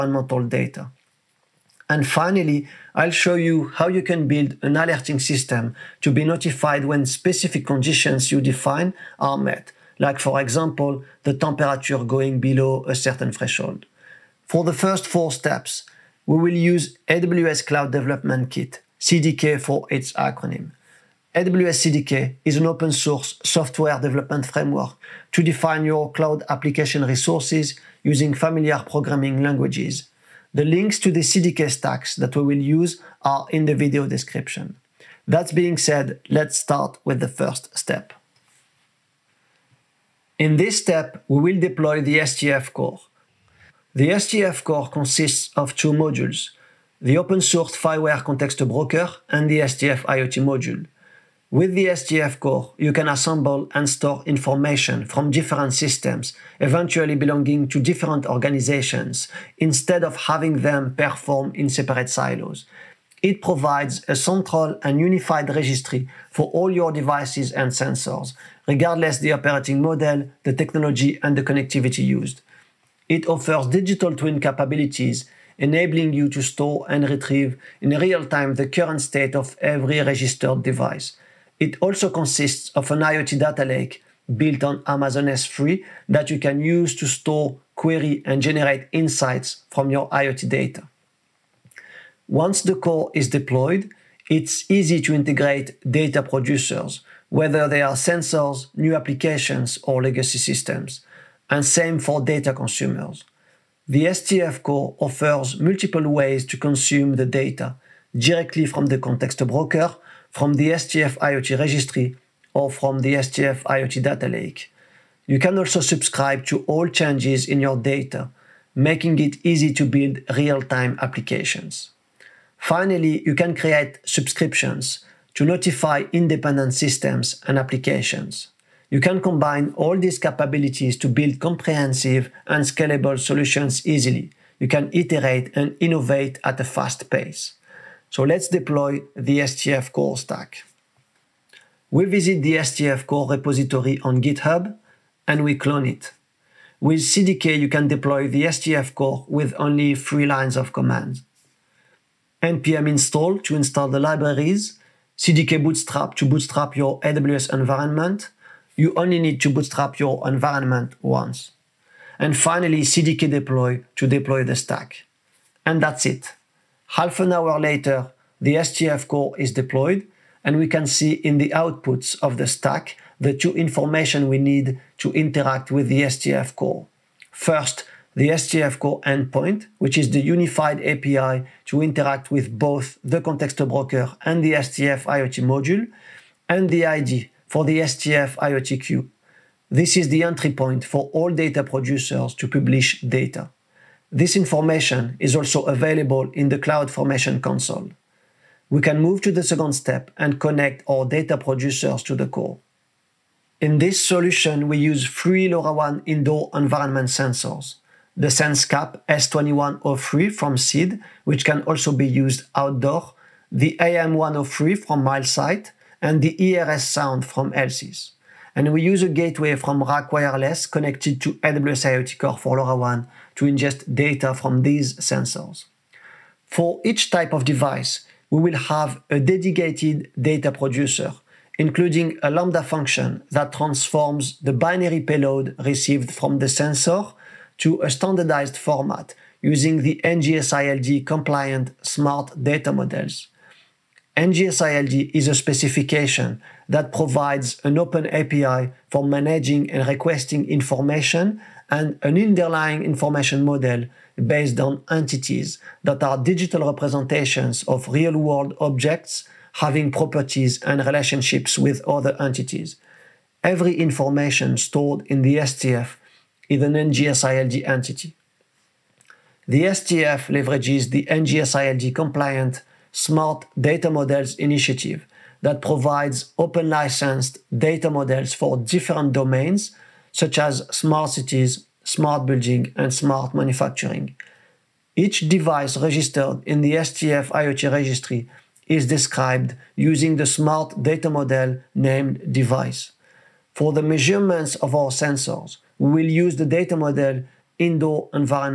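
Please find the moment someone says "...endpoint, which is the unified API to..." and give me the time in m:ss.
2:59.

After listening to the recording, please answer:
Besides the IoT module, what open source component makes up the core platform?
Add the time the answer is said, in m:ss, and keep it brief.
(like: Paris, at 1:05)
FIWARE Context Broker, at 0:47.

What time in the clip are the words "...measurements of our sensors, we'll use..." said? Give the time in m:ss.
4:53.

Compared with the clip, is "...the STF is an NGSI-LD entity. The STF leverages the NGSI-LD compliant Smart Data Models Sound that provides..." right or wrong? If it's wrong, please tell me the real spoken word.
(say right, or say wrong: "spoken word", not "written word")
wrong: "Initiative", not "Sound".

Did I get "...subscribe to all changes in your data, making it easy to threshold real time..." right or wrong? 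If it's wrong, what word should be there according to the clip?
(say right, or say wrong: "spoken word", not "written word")
wrong: "build", not "threshold".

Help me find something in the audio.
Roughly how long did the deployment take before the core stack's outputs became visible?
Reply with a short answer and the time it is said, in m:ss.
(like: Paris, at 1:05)
Half an hour, at 2:46.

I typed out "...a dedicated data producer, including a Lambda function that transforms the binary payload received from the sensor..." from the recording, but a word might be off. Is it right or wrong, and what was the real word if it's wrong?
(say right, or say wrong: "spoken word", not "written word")
right.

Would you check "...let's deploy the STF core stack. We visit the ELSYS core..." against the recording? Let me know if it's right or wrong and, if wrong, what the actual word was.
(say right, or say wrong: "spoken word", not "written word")
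wrong: "STF", not "ELSYS".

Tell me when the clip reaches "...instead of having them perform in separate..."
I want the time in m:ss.
0:59.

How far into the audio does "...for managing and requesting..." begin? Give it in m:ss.
4:08.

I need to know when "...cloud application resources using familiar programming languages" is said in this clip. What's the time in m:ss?
0:26.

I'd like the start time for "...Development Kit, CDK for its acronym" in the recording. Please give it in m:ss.
0:17.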